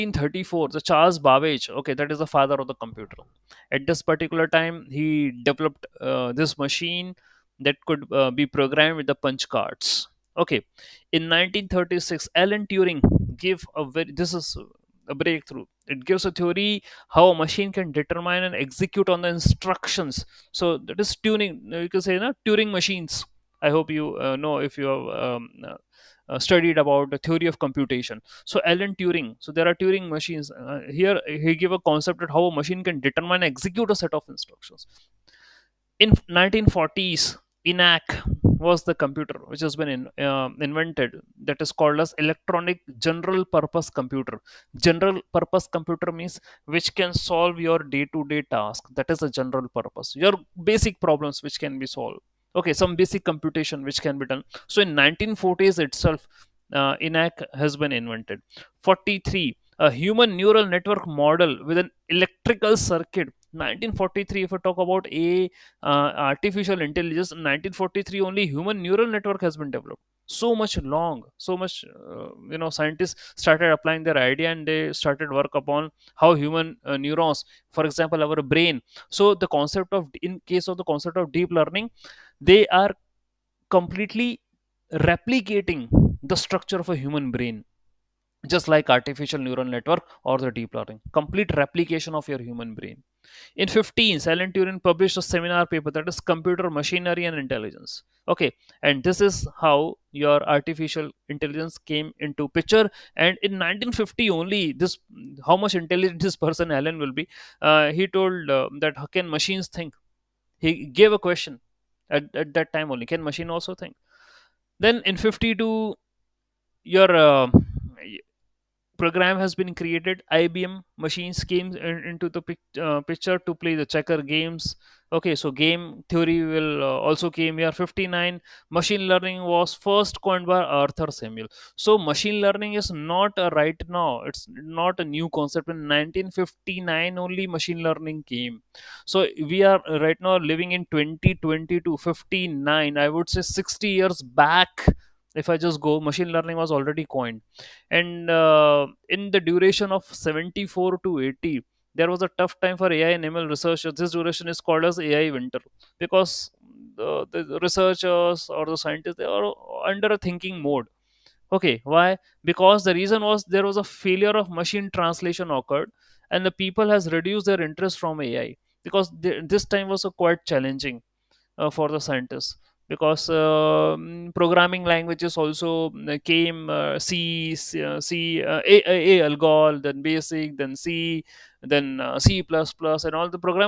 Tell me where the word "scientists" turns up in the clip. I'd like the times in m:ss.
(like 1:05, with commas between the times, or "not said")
1:12, 2:38, 2:51.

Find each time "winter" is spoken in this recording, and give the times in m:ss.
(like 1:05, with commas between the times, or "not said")
2:35.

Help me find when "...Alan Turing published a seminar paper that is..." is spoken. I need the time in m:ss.
1:34.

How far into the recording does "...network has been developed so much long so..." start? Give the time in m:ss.
1:09.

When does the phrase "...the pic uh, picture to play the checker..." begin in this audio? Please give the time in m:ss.
2:02.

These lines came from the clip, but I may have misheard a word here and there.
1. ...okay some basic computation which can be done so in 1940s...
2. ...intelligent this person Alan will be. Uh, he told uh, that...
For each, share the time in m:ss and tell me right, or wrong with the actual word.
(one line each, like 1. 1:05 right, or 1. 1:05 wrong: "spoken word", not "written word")
1. 0:52 right
2. 1:45 right.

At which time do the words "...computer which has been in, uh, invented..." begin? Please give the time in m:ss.
0:39.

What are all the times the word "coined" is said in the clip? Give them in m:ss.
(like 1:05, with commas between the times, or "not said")
2:10, 2:27.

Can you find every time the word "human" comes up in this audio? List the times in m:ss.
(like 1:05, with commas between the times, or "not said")
0:59, 1:08, 1:16, 1:27, 1:32.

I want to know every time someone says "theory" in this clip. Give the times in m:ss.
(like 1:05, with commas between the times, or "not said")
0:16, 0:27, 2:06.